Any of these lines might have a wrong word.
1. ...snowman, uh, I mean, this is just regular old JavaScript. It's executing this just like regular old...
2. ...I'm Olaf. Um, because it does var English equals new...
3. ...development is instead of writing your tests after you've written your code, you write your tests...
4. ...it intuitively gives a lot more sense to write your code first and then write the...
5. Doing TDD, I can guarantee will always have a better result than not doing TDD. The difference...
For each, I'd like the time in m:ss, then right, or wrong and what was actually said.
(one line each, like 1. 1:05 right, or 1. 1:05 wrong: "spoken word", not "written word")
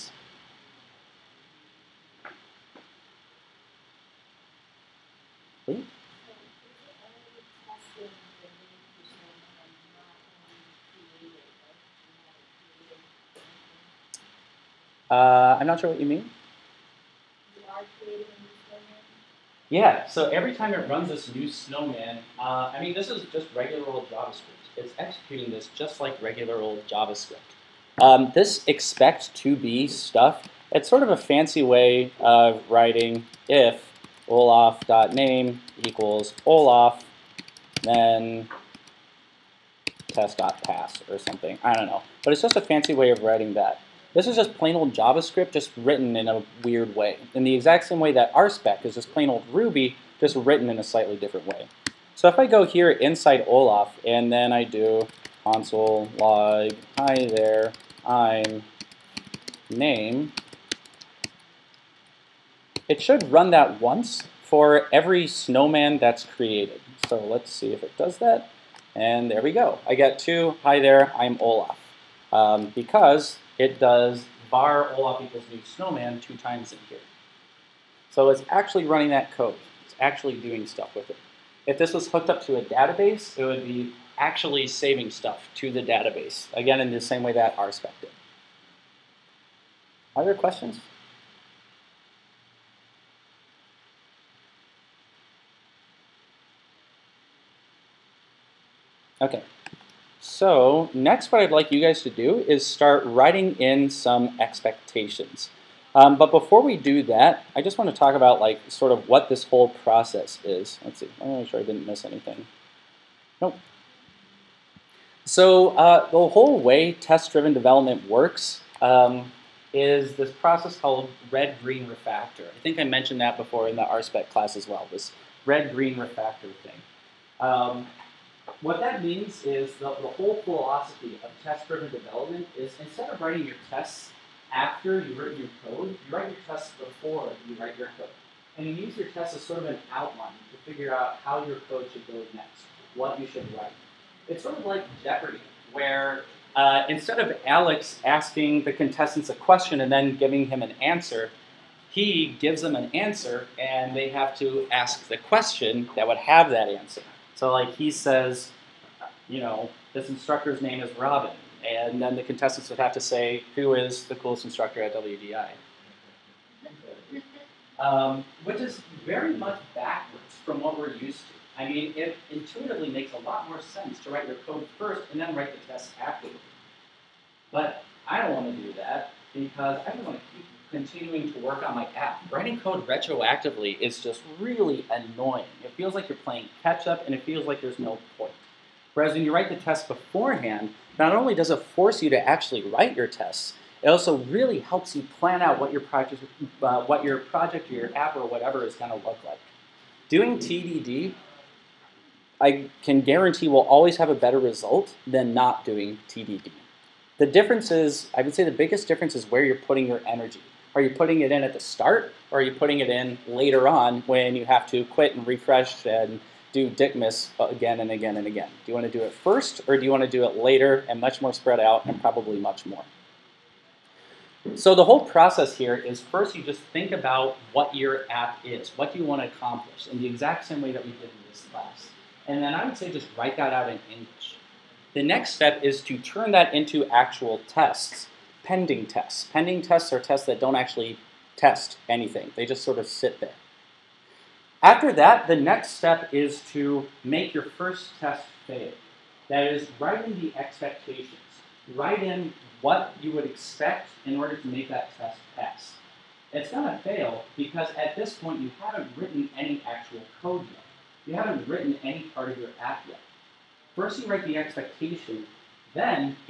1. 0:21 right
2. 1:11 wrong: "Olaf", not "English"
3. 2:11 right
4. 2:51 wrong: "makes", not "gives"
5. 3:20 right.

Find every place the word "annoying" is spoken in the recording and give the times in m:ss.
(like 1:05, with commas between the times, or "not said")
3:04.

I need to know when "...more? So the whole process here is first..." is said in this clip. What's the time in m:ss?
3:42.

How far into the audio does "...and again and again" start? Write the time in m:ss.
3:37.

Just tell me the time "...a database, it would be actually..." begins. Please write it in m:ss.
1:22.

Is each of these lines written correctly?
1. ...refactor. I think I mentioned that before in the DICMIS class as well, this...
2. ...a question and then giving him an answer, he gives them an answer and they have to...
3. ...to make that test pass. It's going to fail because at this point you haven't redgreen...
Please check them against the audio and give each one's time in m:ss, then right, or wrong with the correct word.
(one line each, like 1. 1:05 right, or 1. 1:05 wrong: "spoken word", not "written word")
1. 2:01 wrong: "RSpec", not "DICMIS"
2. 2:29 right
3. 4:14 wrong: "written", not "redgreen".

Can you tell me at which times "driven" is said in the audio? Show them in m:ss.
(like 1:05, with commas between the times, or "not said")
1:56, 2:11.